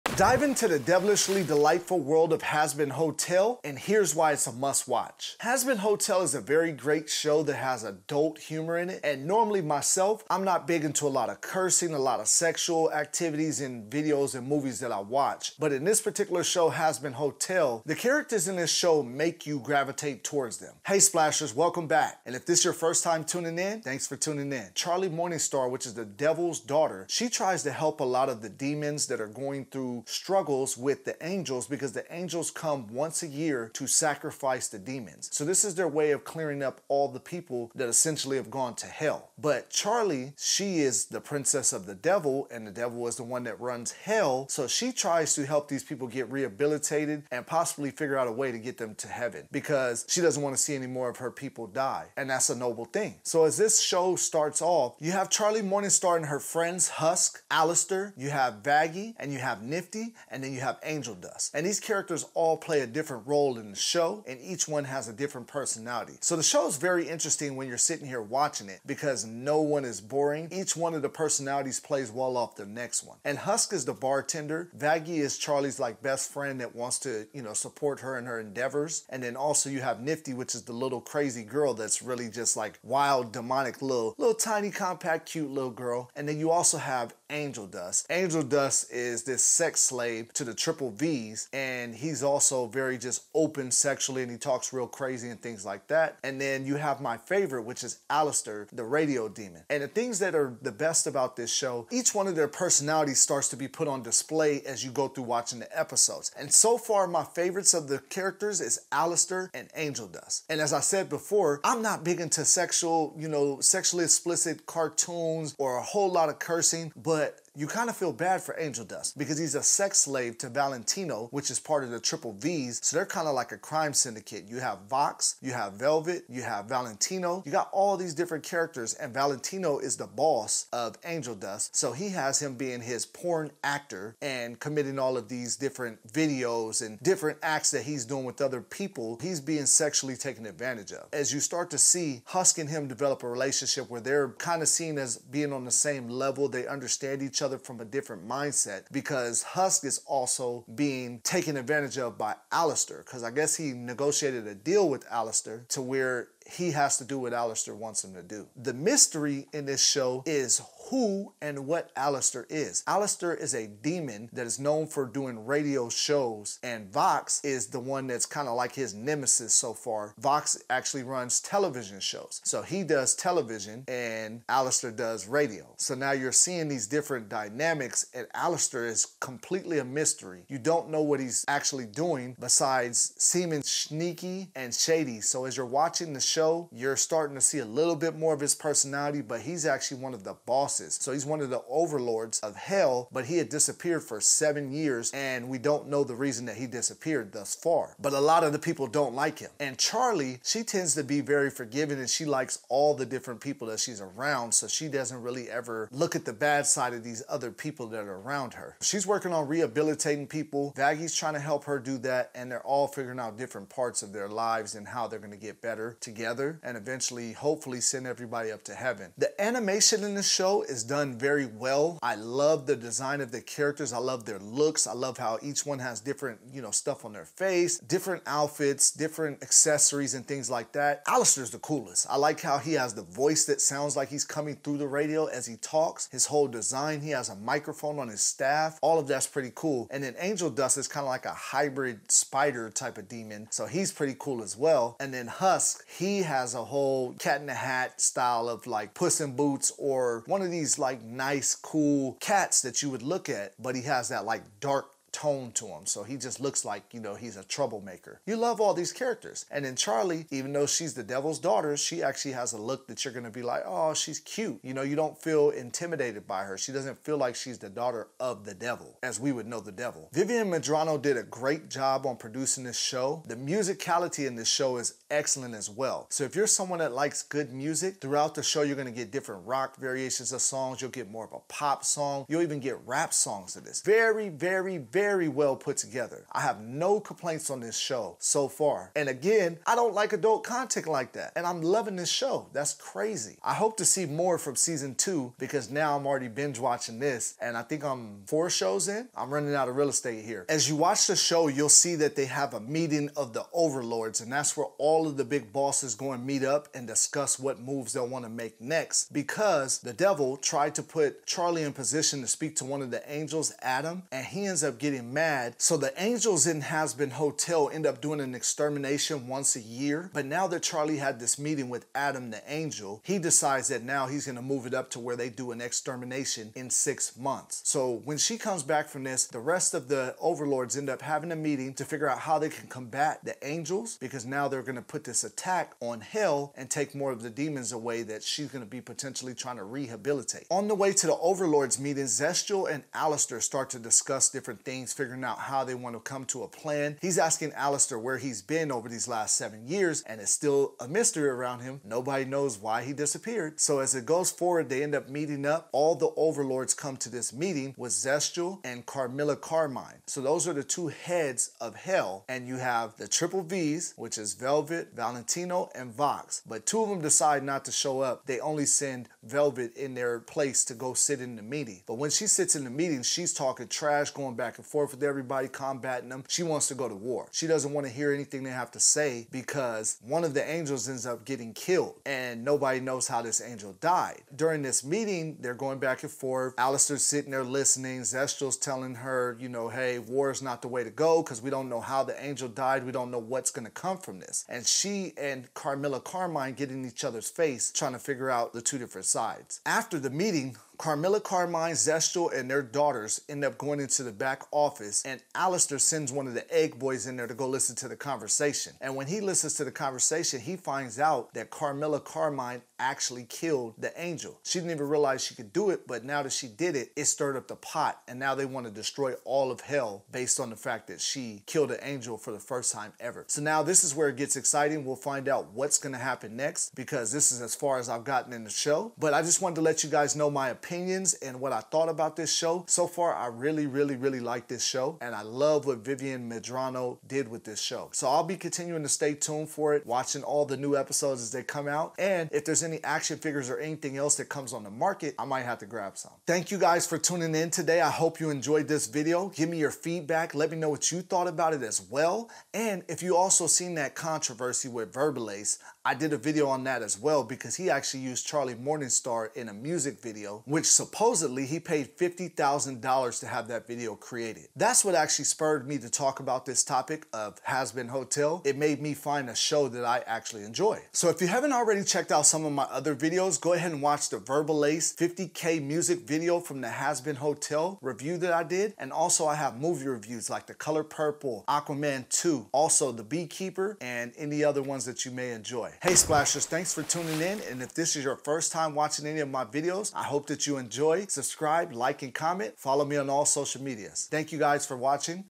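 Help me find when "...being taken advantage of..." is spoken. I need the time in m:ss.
2:30.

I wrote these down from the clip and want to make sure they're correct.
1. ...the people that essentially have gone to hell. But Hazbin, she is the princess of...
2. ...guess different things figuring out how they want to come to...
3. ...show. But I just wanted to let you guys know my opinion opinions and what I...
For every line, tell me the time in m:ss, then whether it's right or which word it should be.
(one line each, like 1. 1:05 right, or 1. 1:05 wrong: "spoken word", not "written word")
1. 0:37 wrong: "Charlie", not "Hazbin"
2. 5:43 wrong: "discuss", not "guess"
3. 7:08 right.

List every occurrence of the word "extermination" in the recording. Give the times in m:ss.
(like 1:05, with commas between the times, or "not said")
5:18, 5:25.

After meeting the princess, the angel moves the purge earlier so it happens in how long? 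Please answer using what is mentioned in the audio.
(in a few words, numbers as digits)
6 months.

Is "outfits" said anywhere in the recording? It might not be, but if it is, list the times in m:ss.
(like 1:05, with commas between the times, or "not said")
3:48.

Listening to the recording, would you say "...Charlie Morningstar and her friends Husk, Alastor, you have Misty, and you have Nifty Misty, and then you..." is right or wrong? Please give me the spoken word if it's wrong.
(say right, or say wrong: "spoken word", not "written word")
wrong: "Vaggie", not "Misty".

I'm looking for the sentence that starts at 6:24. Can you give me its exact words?
During this meeting, they're going back and forth.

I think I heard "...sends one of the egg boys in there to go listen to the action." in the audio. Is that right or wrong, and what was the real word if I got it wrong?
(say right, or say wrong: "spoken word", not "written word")
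wrong: "conversation", not "action".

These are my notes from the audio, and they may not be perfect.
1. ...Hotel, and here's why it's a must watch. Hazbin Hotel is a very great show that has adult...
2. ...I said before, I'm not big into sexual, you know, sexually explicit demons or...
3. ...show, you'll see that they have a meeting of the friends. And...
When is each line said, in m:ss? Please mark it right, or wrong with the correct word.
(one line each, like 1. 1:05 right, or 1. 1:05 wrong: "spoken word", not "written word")
1. 0:02 right
2. 1:50 wrong: "cartoons", not "demons"
3. 5:01 wrong: "overlords", not "friends".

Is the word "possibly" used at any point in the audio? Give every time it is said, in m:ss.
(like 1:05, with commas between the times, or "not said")
0:47.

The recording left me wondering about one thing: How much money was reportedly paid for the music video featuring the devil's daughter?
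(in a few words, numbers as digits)
$50,000.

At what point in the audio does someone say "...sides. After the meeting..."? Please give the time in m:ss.
6:39.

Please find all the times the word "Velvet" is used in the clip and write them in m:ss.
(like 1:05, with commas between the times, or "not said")
2:05, 6:04, 6:09.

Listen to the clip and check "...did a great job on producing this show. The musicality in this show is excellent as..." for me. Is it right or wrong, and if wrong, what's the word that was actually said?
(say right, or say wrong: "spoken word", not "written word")
right.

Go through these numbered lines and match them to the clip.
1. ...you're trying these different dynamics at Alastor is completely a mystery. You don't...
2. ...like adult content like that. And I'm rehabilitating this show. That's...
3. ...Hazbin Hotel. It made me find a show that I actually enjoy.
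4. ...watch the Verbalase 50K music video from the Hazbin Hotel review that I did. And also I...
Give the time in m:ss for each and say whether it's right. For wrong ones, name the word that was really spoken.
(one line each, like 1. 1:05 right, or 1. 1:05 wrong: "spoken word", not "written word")
1. 2:56 wrong: "seeing", not "trying"
2. 4:49 wrong: "loving", not "rehabilitating"
3. 7:47 right
4. 7:53 right.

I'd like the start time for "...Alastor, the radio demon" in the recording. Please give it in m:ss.
1:38.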